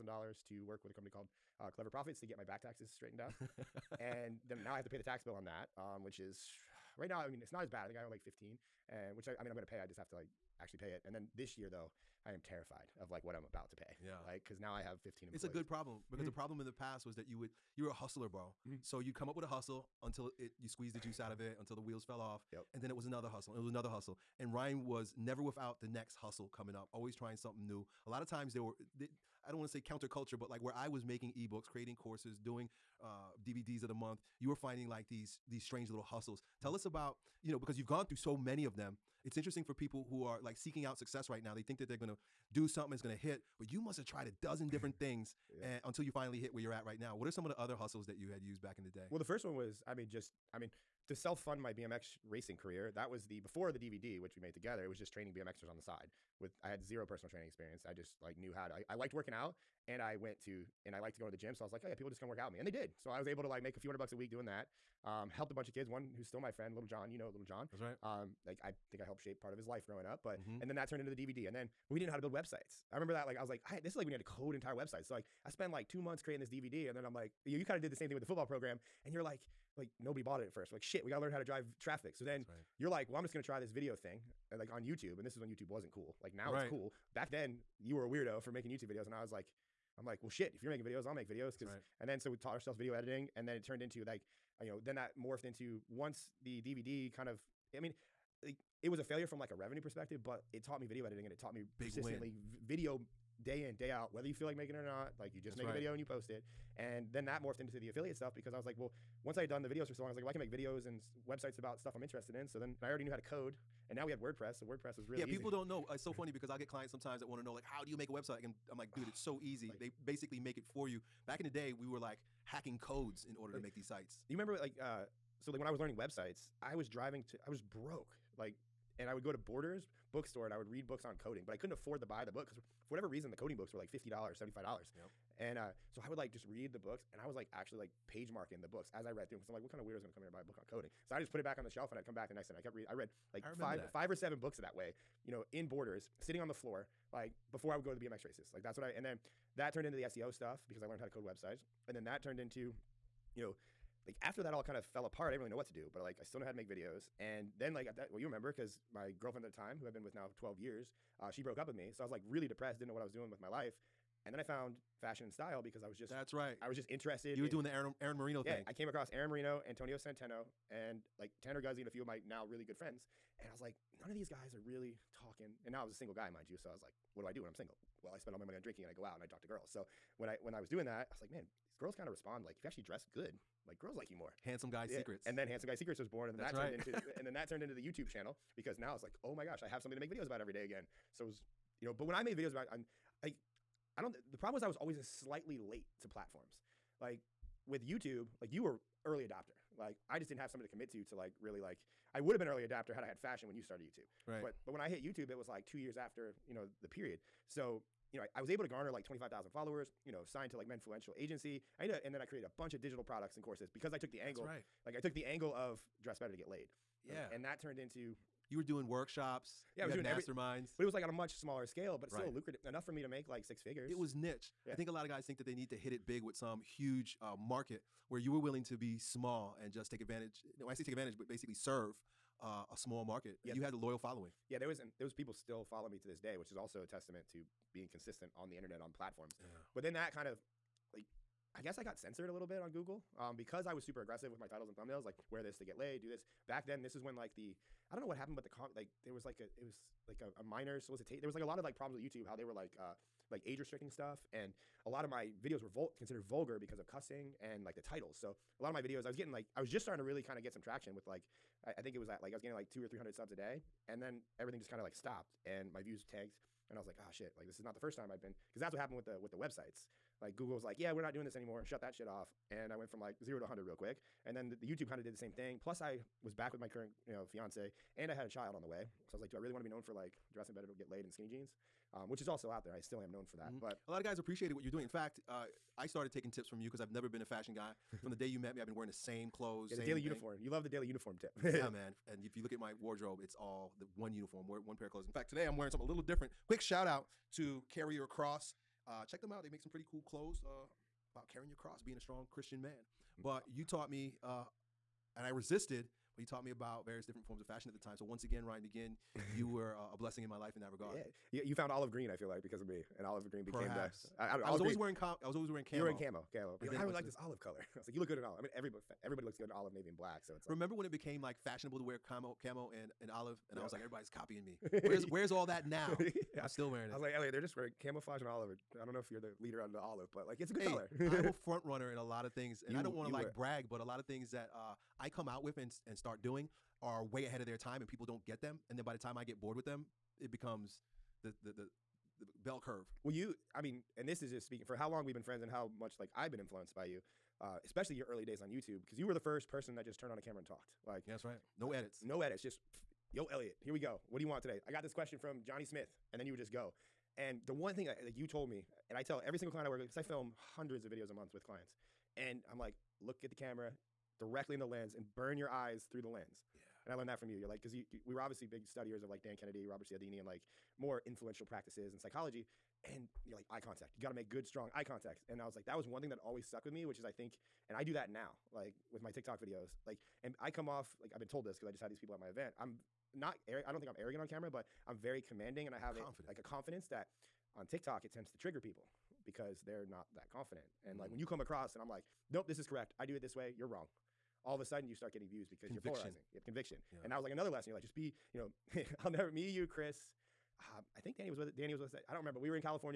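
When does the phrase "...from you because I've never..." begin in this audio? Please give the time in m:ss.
4:46.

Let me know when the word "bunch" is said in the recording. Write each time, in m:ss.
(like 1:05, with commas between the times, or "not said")
1:05, 3:32.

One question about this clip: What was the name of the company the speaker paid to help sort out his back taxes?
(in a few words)
Clever Profits.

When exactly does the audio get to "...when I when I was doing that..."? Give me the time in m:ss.
3:00.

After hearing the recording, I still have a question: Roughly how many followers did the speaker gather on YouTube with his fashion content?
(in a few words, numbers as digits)
25,000.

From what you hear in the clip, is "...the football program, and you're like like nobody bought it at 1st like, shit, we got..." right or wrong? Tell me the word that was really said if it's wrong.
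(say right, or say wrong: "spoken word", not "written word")
right.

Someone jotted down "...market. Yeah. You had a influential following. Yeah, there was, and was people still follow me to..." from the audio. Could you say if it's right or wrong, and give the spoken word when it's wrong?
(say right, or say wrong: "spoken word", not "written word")
wrong: "loyal", not "influential".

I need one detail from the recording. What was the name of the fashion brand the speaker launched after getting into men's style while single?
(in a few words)
Handsome Guy Secrets.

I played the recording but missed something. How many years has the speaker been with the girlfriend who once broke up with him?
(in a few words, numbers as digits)
12.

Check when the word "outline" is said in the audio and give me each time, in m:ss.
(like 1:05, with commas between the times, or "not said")
not said.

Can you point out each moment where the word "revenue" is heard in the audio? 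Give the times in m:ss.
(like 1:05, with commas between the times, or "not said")
1:39.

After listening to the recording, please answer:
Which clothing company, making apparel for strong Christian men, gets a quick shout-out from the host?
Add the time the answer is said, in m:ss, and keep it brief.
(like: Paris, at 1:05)
Carrier Cross, at 4:57.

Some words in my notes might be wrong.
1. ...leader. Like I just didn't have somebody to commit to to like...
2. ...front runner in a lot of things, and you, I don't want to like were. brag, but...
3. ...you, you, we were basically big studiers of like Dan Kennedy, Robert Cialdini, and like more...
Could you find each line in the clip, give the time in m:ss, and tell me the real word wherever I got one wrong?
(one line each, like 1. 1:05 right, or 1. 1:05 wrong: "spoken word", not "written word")
1. 3:19 wrong: "adopter", not "leader"
2. 5:31 right
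3. 6:07 wrong: "obviously", not "basically".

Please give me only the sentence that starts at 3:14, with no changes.
The problem was I was always slightly late to platforms.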